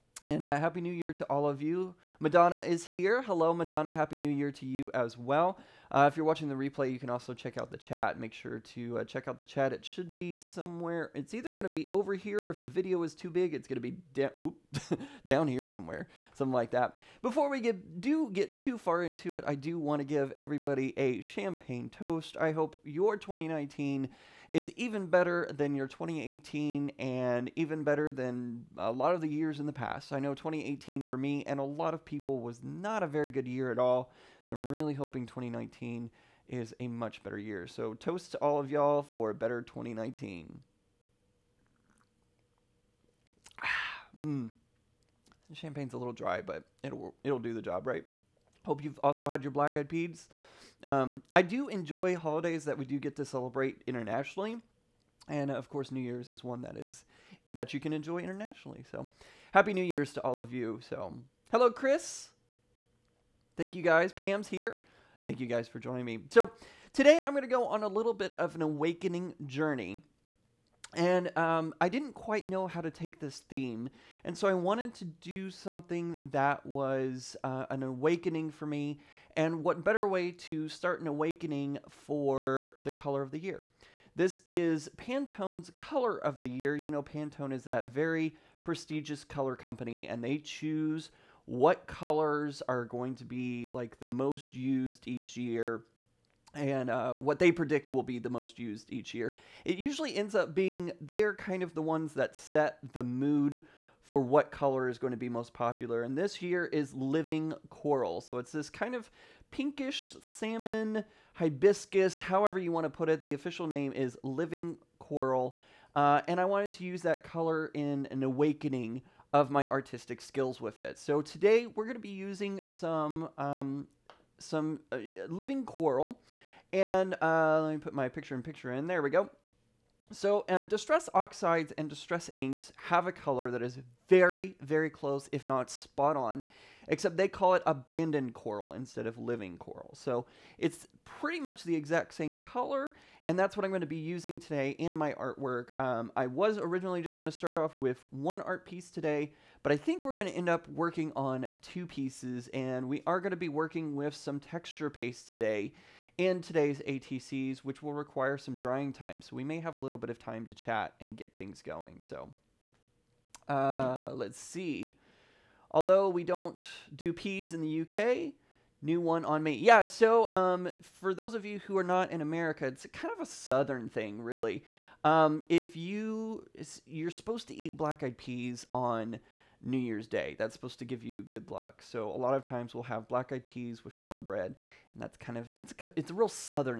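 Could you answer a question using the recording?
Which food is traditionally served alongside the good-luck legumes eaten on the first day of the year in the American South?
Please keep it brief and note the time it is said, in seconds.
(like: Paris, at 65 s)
Cornbread, at 183 s.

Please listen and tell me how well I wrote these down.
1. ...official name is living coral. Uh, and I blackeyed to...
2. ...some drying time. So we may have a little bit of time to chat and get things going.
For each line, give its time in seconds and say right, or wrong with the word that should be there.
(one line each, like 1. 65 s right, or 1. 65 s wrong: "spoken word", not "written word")
1. 113 s wrong: "wanted", not "blackeyed"
2. 158 s right.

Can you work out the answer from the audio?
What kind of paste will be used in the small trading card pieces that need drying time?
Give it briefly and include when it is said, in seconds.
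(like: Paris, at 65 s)
Texture paste, at 154 s.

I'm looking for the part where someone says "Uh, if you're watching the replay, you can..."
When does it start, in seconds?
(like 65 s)
5 s.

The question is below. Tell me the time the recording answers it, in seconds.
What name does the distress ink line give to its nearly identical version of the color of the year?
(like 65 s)
137 s.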